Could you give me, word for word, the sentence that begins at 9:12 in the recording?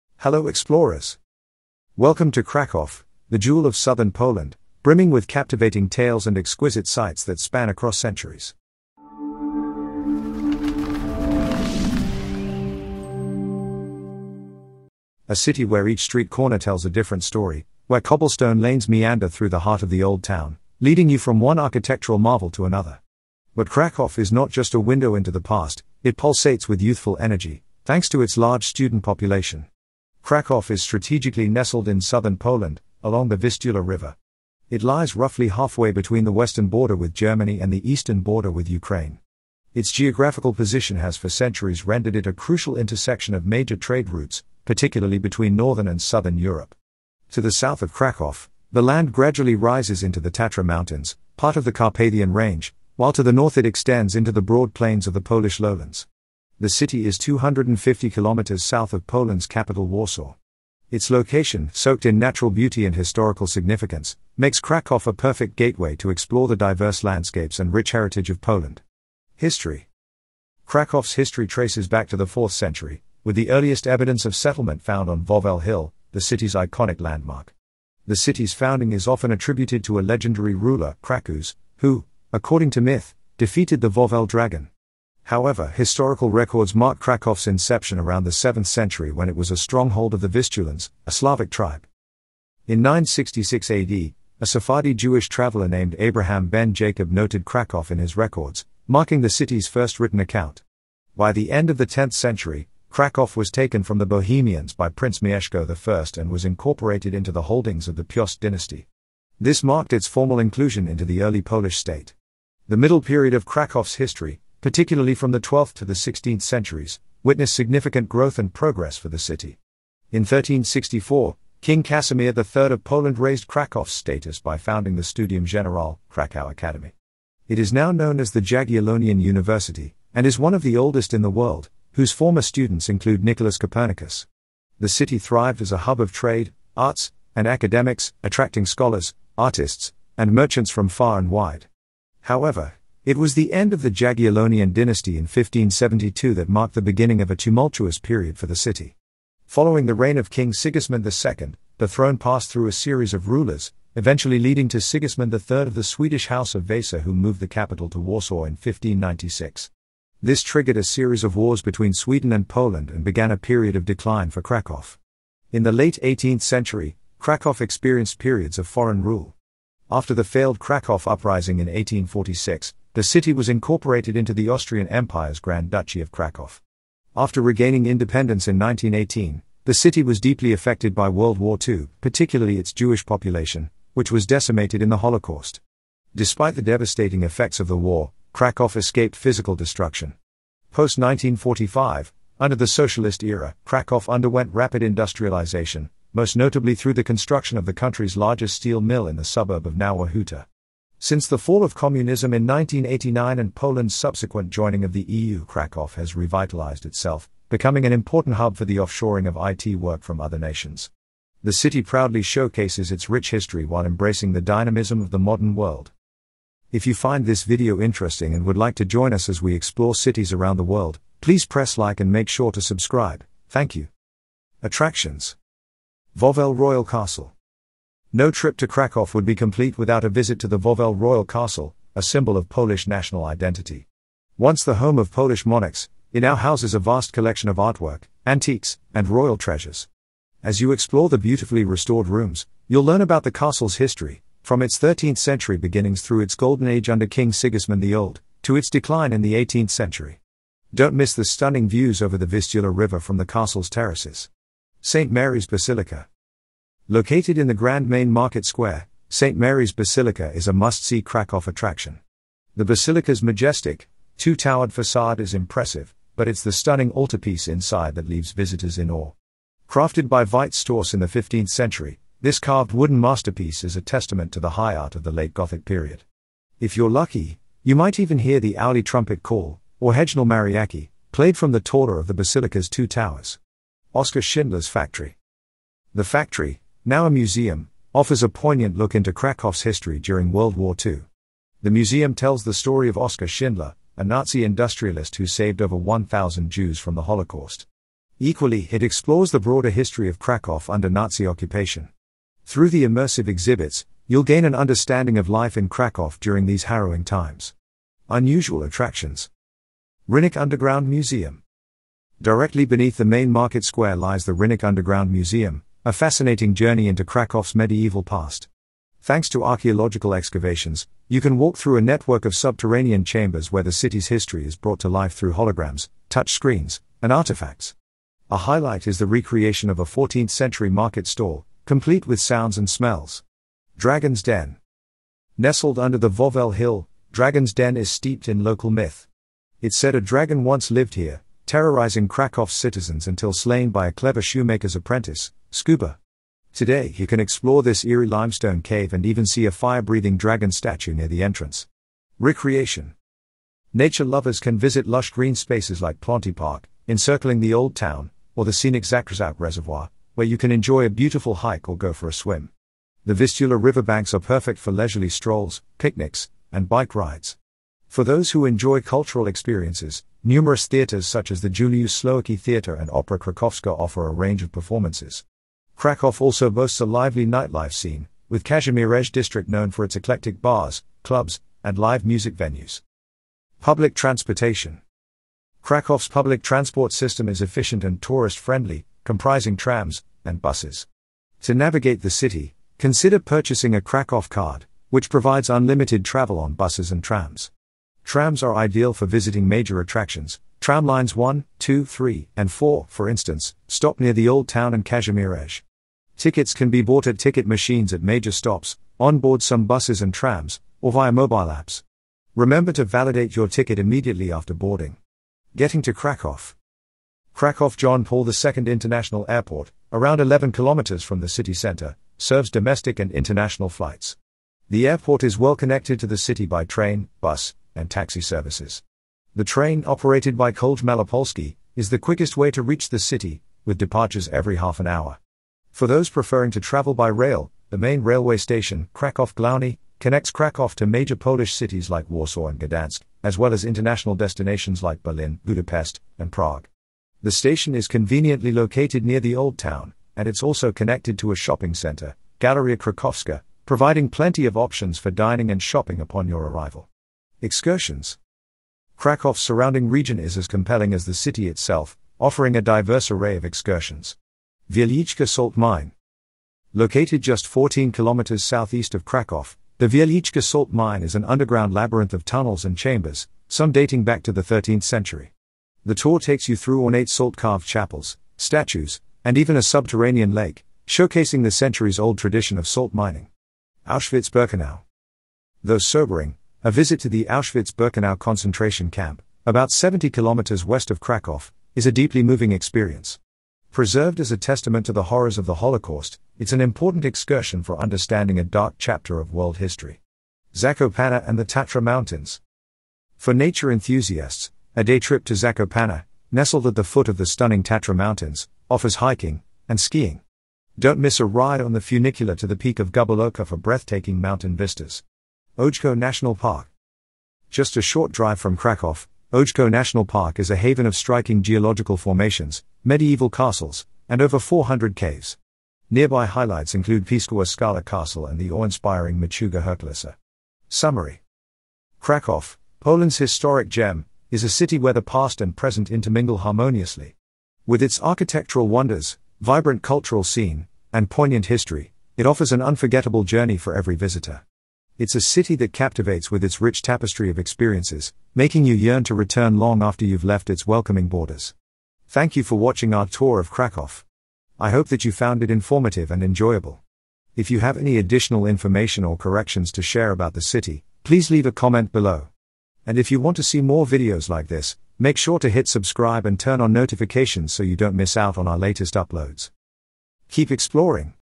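Thank you for watching our tour of Krakow.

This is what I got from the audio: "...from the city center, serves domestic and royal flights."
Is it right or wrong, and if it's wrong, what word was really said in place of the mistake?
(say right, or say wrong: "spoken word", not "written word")
wrong: "international", not "royal".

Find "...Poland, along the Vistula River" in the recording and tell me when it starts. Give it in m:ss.
0:32.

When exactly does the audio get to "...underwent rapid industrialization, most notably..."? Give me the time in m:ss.
3:14.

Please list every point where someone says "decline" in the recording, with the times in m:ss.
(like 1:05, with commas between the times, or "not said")
2:43, 4:08.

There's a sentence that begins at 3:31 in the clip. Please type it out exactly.
The city proudly showcases its rich history while embracing the dynamism of the modern world.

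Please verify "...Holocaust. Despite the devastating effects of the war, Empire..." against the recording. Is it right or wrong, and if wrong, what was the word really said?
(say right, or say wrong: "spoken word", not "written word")
wrong: "Krakow", not "Empire".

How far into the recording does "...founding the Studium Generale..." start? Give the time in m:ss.
2:04.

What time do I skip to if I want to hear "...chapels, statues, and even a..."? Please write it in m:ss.
7:57.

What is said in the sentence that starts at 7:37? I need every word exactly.
Excursions Krakow's surrounding region is as compelling as the city itself, offering a diverse array of excursions.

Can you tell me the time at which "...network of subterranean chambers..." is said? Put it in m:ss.
5:21.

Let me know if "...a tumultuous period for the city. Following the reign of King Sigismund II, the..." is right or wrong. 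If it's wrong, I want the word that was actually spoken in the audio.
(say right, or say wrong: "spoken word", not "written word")
right.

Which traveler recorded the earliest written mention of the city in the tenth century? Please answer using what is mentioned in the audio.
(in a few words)
Abraham ben Jacob.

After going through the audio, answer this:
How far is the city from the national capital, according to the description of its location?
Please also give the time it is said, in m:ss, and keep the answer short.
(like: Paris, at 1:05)
250 kilometers, at 0:57.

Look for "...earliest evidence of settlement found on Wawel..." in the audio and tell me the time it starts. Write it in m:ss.
1:13.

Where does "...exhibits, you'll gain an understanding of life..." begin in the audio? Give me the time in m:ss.
5:03.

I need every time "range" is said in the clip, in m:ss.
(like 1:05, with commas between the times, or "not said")
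0:52, 6:14.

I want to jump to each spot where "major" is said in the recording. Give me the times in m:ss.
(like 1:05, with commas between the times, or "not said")
0:43, 6:39, 6:48, 7:20.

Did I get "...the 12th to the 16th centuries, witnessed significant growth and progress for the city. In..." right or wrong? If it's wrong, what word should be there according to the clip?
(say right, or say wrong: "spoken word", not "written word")
right.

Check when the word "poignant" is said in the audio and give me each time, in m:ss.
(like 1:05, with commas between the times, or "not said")
4:48, 9:01.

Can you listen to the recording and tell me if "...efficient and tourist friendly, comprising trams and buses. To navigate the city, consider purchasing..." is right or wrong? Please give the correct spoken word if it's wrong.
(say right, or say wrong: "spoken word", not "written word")
right.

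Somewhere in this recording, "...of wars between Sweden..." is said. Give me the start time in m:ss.
2:41.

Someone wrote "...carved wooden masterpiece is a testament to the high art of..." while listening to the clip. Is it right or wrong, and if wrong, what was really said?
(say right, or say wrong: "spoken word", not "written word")
right.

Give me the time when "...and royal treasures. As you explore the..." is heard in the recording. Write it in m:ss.
3:58.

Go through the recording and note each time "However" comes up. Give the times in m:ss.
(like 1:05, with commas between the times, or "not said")
1:25, 2:22.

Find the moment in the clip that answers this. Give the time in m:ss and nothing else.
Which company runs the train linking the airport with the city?
7:10.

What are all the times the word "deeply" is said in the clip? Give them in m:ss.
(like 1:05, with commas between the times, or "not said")
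3:00, 8:11.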